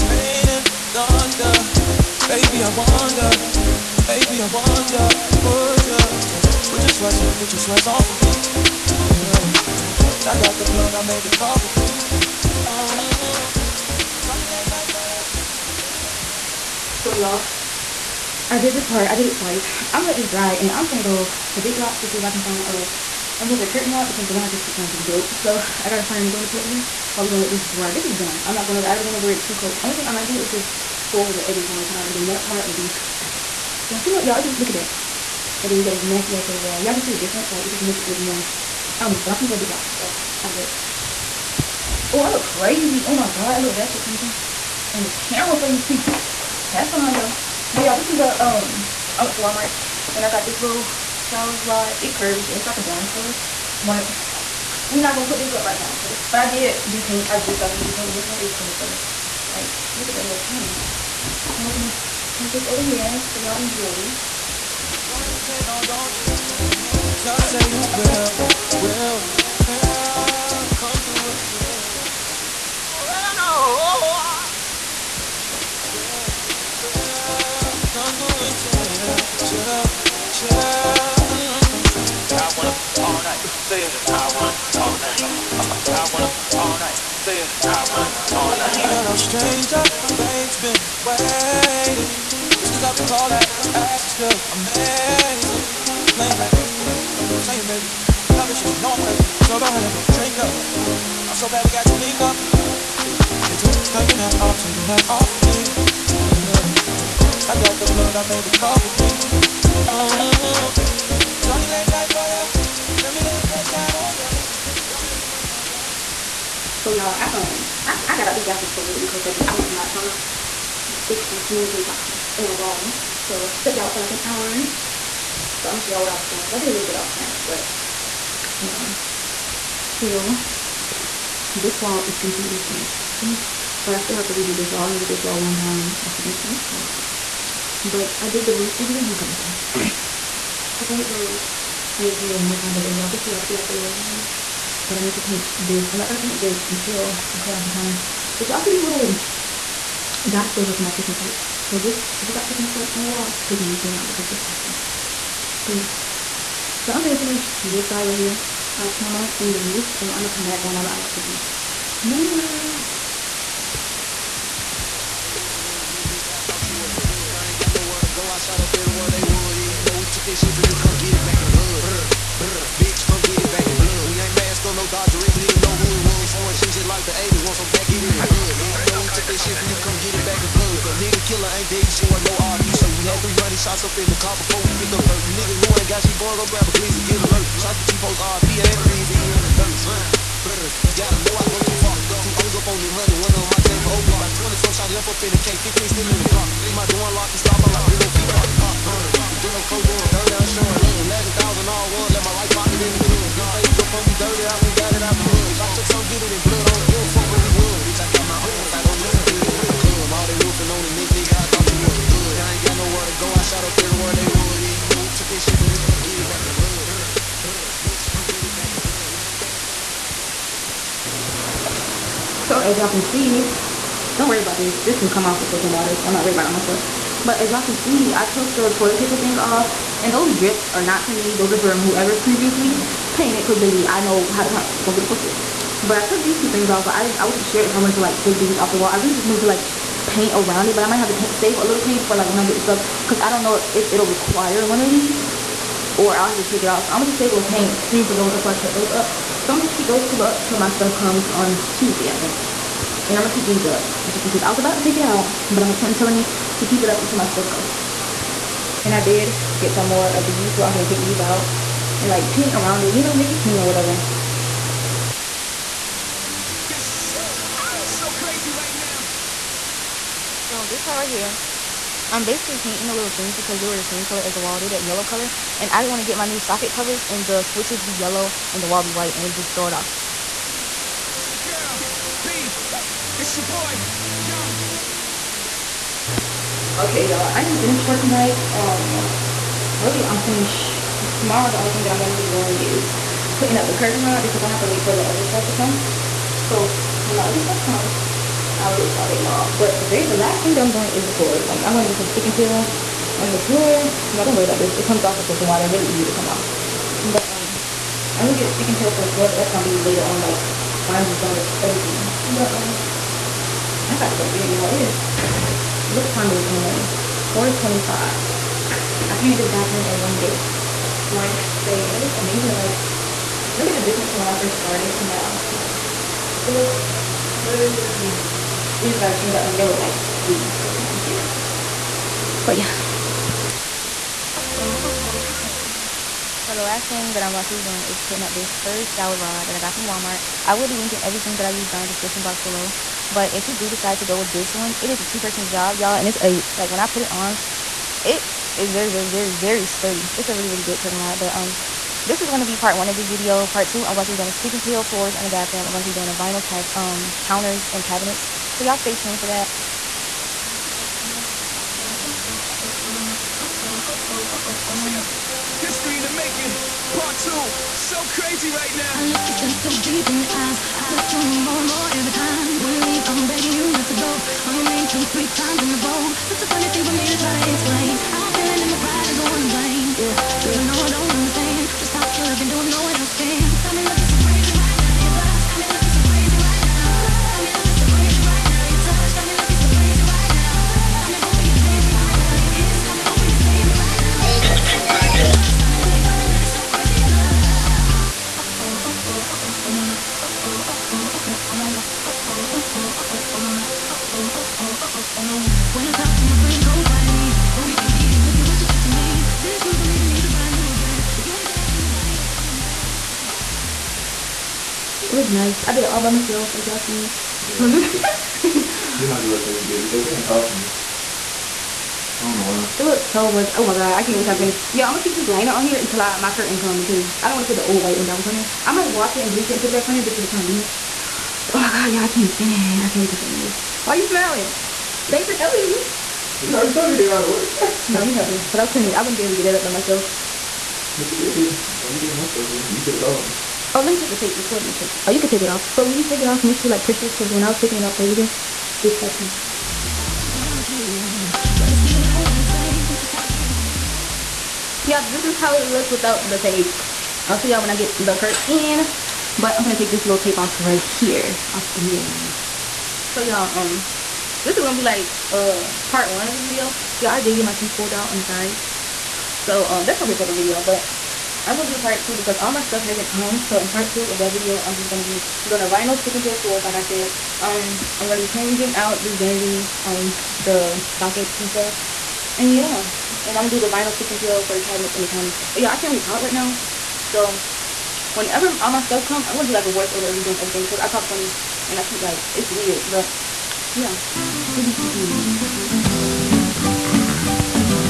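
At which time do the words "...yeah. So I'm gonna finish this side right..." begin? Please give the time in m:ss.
2:35.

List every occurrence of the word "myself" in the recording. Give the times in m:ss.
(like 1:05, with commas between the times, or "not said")
6:56, 7:19.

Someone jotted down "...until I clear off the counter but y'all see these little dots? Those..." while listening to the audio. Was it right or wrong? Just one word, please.
right.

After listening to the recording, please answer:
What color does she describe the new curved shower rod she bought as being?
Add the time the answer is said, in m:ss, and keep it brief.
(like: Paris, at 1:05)
Bronze, at 0:52.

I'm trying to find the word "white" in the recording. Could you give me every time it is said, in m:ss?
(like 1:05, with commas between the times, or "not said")
4:38, 7:07.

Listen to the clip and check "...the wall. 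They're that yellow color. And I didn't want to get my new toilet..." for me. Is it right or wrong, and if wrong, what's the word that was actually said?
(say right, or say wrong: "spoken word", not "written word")
wrong: "socket", not "toilet".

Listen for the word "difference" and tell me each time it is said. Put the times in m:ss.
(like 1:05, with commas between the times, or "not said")
0:37, 5:23.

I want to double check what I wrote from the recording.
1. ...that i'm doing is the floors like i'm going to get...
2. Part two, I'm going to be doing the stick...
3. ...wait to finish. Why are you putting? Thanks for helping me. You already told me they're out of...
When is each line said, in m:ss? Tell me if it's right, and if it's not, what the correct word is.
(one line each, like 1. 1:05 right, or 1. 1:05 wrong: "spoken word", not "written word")
1. 5:00 right
2. 5:53 right
3. 7:13 wrong: "smiling", not "putting".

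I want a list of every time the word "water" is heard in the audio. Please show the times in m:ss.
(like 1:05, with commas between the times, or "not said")
3:45, 5:05.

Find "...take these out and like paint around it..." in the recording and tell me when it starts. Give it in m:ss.
4:20.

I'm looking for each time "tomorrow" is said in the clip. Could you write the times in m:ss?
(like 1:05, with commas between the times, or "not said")
4:51.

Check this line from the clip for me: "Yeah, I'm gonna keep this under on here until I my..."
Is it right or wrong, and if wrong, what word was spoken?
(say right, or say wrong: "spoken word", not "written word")
wrong: "liner", not "under".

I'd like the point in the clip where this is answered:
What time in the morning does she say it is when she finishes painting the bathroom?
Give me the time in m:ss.
5:17.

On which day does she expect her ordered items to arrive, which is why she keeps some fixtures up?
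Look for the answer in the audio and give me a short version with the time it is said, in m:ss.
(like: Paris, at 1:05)
Tuesday, at 4:11.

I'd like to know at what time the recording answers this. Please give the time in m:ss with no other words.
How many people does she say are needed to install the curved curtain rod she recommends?
5:45.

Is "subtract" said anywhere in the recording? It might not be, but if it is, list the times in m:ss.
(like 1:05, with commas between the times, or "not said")
not said.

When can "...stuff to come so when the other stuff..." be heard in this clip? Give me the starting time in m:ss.
4:55.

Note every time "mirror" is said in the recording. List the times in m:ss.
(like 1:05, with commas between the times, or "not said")
2:42, 7:41.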